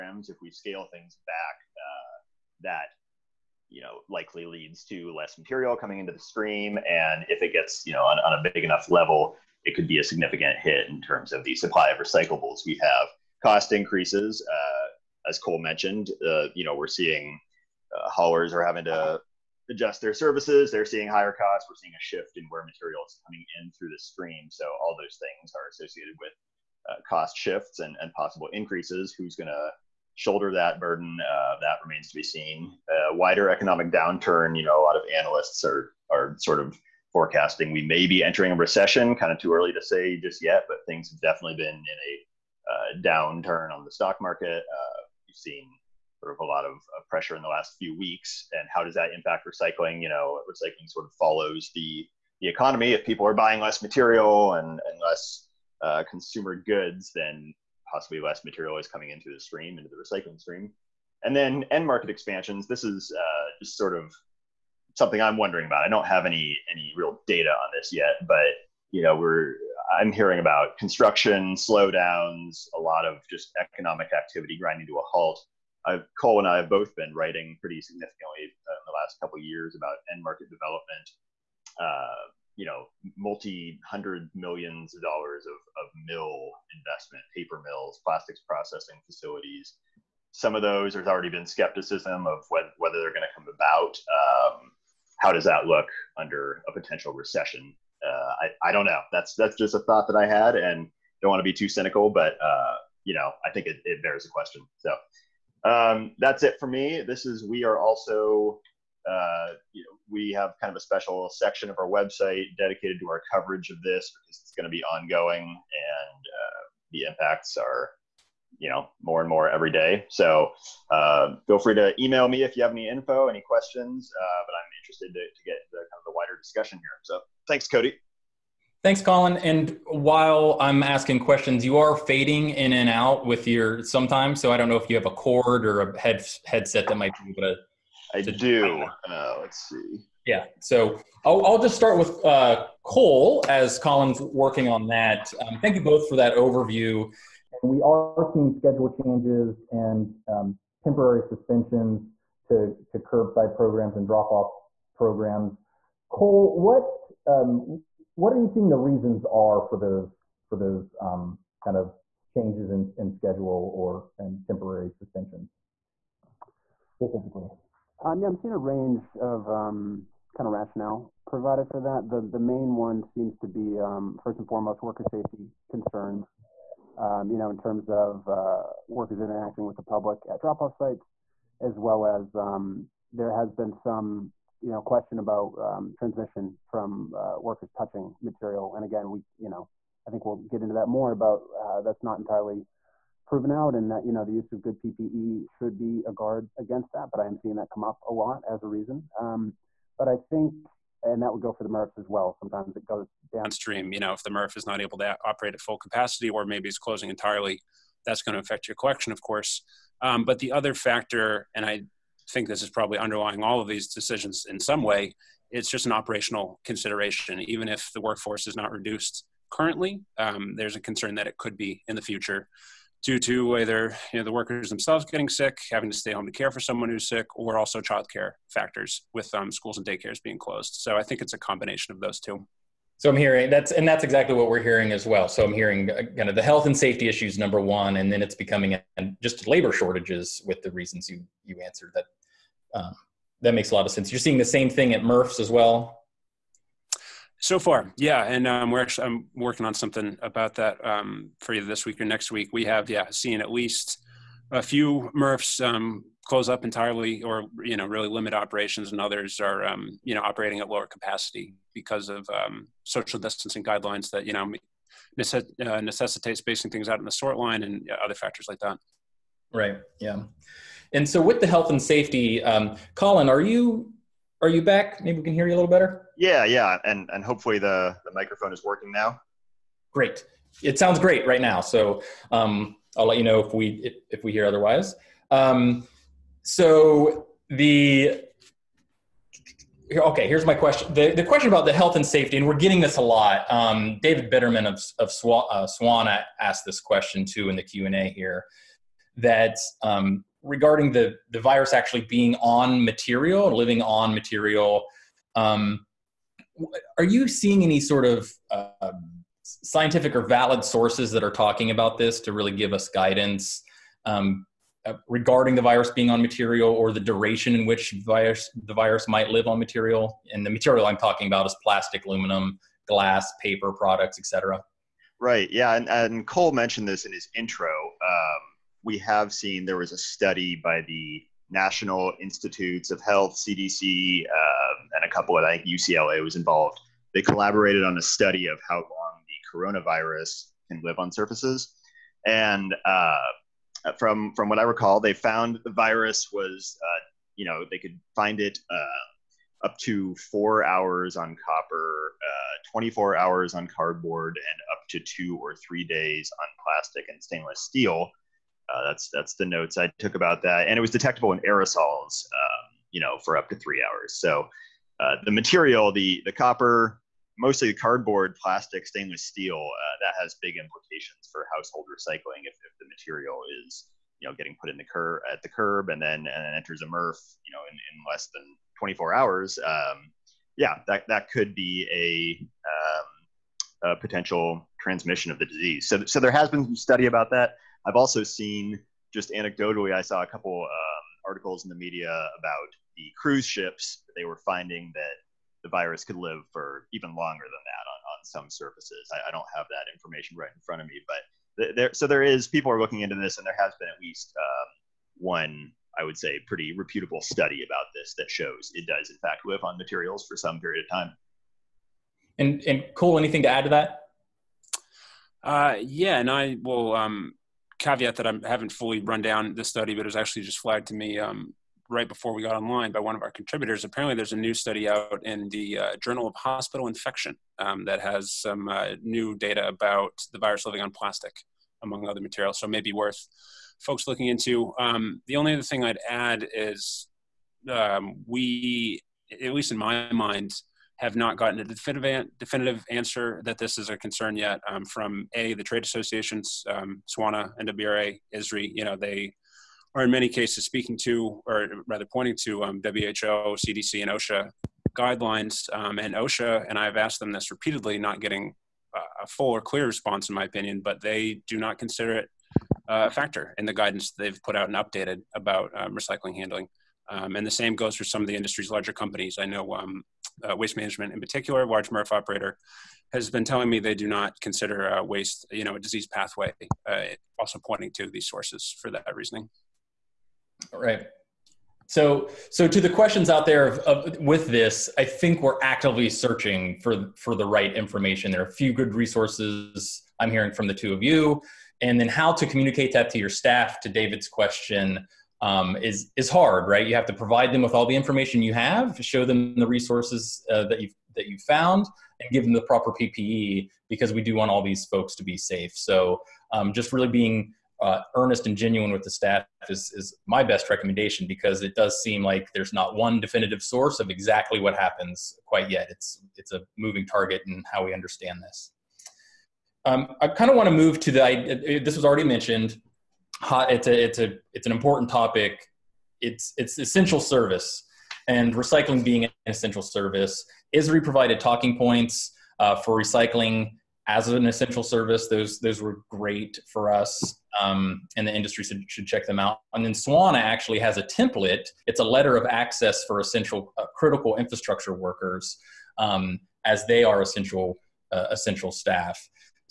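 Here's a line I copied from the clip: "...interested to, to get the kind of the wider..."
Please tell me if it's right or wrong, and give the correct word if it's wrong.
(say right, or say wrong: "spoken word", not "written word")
right.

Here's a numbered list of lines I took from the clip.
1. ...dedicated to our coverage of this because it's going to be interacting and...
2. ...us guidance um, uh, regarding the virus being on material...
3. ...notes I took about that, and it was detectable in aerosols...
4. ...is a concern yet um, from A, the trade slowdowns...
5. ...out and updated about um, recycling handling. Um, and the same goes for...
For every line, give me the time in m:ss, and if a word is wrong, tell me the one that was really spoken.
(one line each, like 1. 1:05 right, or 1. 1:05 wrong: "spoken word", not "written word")
1. 1:52 wrong: "ongoing", not "interacting"
2. 5:12 right
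3. 5:59 right
4. 7:23 wrong: "associations", not "slowdowns"
5. 7:44 right.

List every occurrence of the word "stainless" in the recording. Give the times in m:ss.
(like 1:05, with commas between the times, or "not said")
5:57, 6:08.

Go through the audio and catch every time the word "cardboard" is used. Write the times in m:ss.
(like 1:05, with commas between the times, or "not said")
5:53, 6:07.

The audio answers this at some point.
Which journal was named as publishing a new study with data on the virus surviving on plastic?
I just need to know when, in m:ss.
7:05.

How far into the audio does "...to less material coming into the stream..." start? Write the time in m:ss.
0:04.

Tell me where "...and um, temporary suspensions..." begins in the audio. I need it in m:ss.
2:29.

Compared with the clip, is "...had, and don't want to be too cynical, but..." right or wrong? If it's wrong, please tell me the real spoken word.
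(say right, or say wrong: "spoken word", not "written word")
right.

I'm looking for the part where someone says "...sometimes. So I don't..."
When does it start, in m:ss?
2:13.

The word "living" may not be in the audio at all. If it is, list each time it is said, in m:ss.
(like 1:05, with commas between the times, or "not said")
5:03, 7:10.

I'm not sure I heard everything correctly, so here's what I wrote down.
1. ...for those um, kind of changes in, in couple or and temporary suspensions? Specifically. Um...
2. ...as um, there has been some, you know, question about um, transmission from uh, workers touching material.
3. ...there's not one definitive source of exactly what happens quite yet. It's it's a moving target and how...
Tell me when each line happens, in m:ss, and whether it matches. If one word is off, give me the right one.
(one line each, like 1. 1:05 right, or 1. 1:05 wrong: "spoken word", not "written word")
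1. 2:40 wrong: "schedule", not "couple"
2. 3:02 right
3. 8:32 right.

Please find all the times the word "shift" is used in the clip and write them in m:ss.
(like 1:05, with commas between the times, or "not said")
0:22, 0:27.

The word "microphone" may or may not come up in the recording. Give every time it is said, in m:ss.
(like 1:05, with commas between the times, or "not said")
4:38.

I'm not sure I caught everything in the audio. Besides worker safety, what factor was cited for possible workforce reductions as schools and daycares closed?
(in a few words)
Childcare.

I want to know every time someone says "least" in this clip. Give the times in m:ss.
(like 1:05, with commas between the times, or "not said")
4:13, 6:44, 7:19.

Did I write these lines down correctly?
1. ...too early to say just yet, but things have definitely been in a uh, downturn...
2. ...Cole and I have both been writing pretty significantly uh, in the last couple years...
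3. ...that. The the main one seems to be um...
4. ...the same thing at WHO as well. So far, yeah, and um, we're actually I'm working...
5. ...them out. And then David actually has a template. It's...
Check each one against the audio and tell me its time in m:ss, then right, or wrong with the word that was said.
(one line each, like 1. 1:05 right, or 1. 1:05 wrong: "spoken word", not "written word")
1. 0:39 right
2. 1:16 right
3. 2:51 right
4. 4:04 wrong: "MRFs", not "WHO"
5. 8:59 wrong: "Swana", not "David".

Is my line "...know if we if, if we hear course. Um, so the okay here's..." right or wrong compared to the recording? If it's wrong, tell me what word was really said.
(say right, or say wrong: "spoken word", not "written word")
wrong: "otherwise", not "course".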